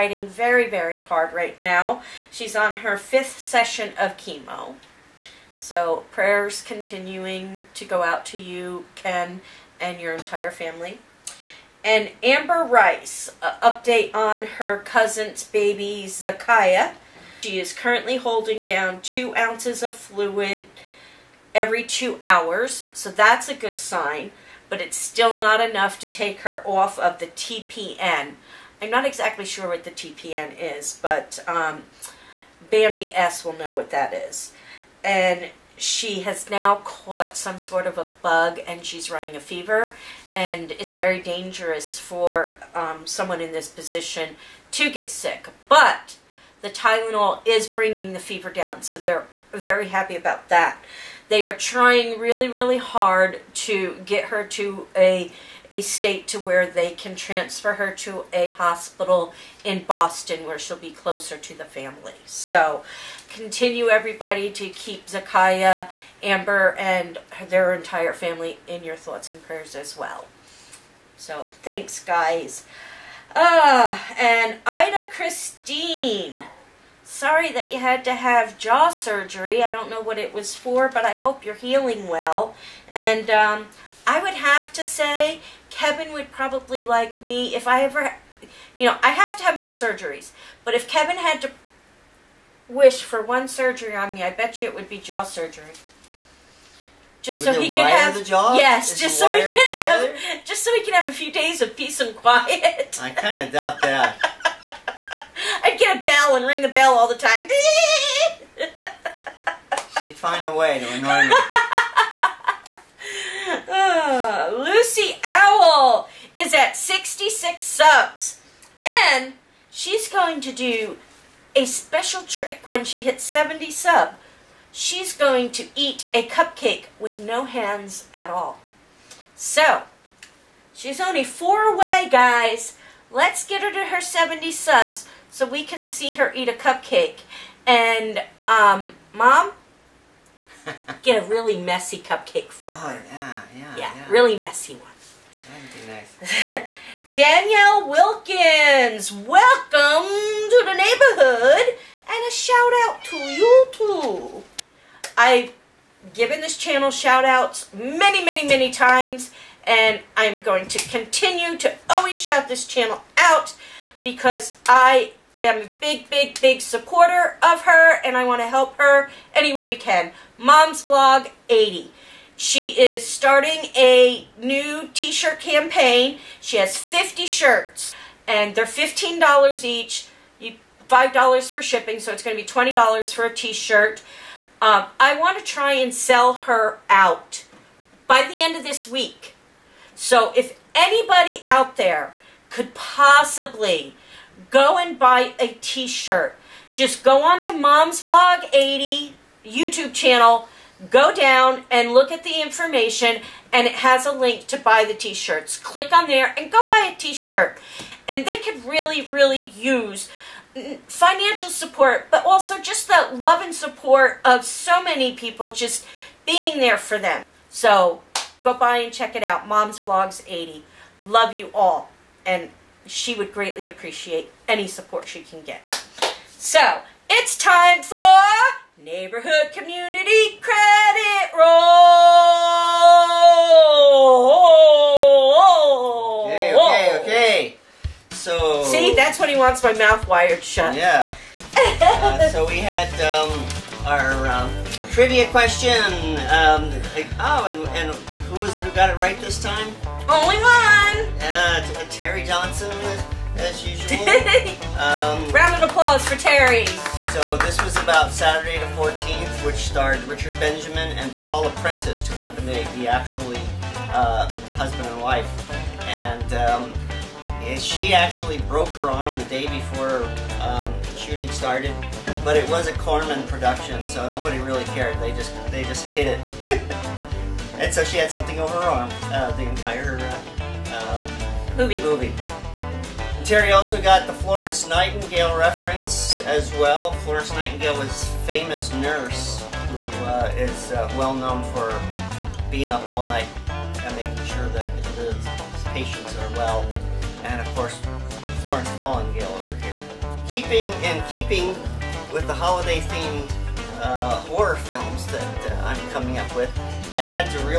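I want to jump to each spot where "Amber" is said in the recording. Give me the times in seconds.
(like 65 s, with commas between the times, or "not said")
12 s, 66 s.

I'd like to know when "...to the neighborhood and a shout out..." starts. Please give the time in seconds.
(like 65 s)
150 s.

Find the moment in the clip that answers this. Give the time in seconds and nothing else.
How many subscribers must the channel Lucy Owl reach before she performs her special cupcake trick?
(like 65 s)
123 s.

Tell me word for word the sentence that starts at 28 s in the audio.
I'm not exactly sure what the TPN is, but um, Bambi S will know what that is.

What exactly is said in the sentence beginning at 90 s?
But if Kevin had to wish for one surgery on me, I bet you it would be jaw surgery.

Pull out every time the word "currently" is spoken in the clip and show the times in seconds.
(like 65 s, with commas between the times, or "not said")
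17 s.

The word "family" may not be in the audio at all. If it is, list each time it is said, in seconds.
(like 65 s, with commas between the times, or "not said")
10 s, 61 s, 68 s.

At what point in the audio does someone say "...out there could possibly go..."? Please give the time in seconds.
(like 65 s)
191 s.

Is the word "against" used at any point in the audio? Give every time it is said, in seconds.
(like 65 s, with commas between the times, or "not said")
not said.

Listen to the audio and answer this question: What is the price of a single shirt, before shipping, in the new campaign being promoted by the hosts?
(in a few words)
$15.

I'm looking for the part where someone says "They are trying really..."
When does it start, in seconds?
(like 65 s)
51 s.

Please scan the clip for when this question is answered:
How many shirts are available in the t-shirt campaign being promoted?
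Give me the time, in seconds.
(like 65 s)
176 s.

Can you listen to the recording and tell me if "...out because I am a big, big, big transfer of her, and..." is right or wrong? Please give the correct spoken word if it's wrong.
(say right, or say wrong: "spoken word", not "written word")
wrong: "supporter", not "transfer".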